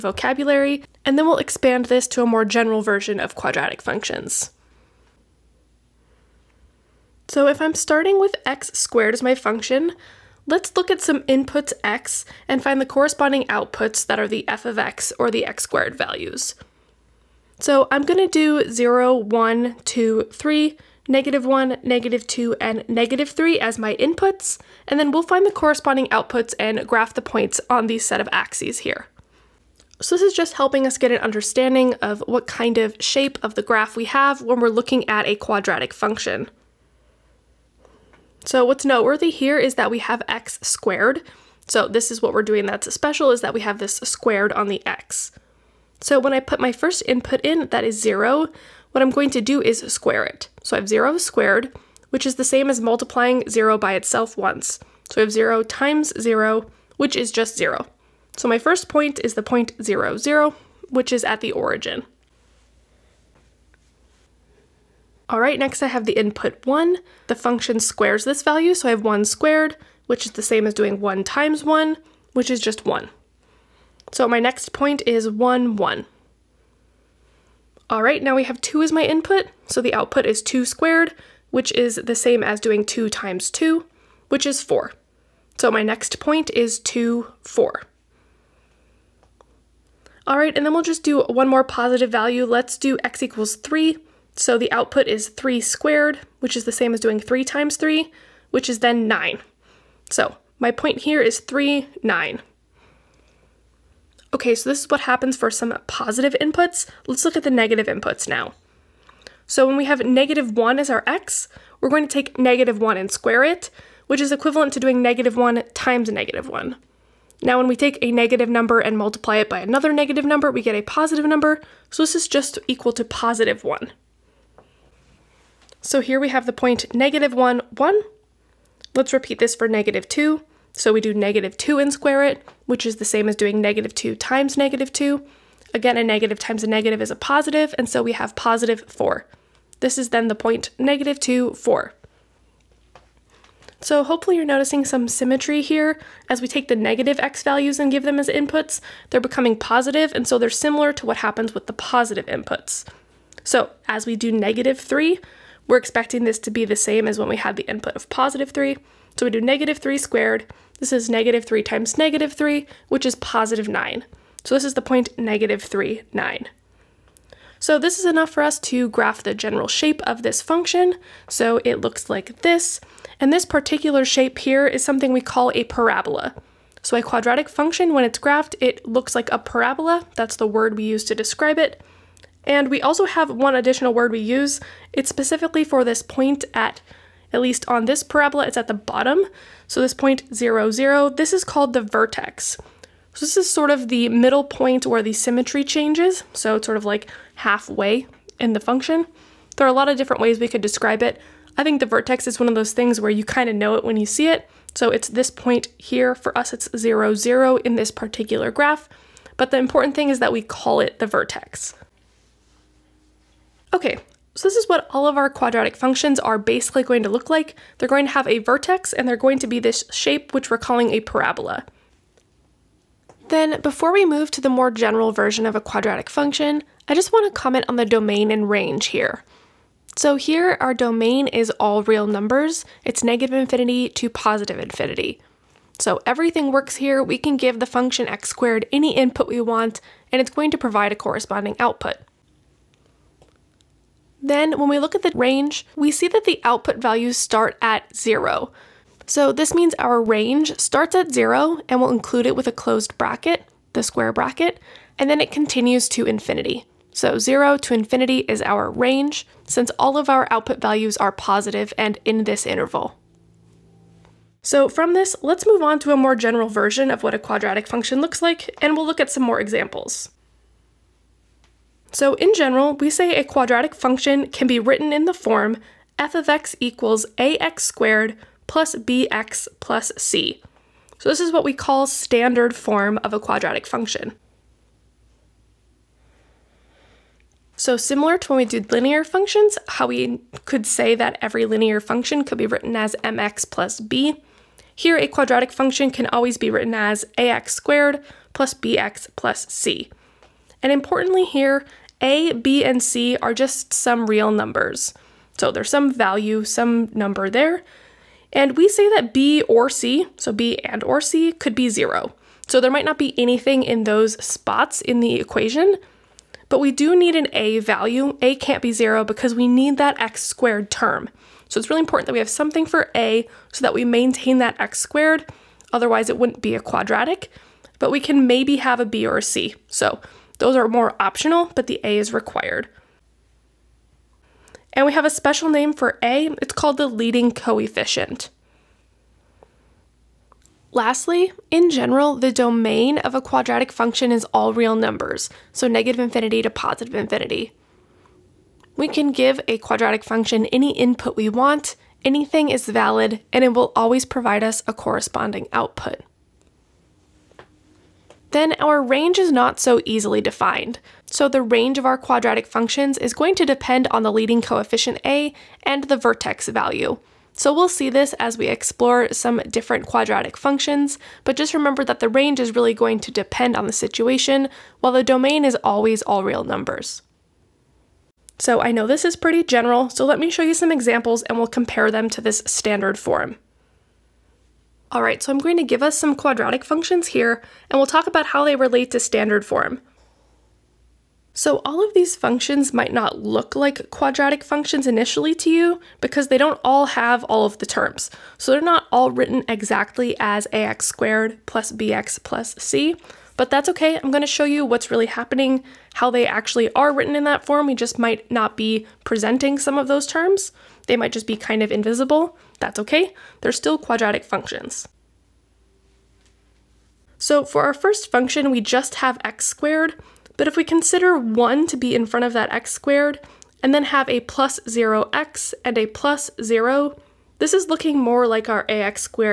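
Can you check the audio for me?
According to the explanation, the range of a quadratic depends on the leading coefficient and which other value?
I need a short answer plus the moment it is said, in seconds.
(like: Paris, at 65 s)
the vertex value, at 365 s.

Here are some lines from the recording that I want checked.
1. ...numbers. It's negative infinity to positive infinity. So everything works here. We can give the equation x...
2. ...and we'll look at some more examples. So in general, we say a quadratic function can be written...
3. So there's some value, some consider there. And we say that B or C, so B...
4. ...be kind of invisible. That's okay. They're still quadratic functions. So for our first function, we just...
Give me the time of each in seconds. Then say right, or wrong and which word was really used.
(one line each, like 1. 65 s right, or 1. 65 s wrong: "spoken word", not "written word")
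1. 232 s wrong: "function", not "equation"
2. 268 s right
3. 305 s wrong: "number", not "consider"
4. 411 s right.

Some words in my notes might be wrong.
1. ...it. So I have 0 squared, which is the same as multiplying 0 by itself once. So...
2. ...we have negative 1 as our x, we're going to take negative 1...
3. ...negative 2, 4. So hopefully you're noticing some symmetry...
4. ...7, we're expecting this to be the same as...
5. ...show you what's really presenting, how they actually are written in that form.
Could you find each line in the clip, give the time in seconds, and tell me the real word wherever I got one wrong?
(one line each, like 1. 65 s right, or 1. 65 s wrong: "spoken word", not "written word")
1. 50 s right
2. 109 s right
3. 140 s right
4. 154 s wrong: "3", not "7"
5. 404 s wrong: "happening", not "presenting".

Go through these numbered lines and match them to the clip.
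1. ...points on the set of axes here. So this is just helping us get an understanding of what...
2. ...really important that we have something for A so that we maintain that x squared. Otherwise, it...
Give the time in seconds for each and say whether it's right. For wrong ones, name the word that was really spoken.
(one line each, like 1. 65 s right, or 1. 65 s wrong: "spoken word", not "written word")
1. 27 s right
2. 321 s right.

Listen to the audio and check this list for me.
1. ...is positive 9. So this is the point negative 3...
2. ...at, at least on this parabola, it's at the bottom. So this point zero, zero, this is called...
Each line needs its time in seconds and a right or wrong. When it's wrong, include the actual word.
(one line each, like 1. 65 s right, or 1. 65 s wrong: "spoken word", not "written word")
1. 163 s right
2. 186 s right.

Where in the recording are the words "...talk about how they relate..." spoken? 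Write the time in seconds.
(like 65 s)
387 s.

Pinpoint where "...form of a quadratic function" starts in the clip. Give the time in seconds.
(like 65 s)
282 s.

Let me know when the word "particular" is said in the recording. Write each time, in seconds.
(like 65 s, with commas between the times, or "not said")
173 s, 207 s.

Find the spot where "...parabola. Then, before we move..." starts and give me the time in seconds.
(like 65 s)
221 s.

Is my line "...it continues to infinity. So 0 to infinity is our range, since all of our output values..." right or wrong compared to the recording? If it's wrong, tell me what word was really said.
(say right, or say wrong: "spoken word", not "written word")
right.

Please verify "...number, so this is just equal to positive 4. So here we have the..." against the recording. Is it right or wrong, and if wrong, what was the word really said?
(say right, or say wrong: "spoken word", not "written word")
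wrong: "1", not "4".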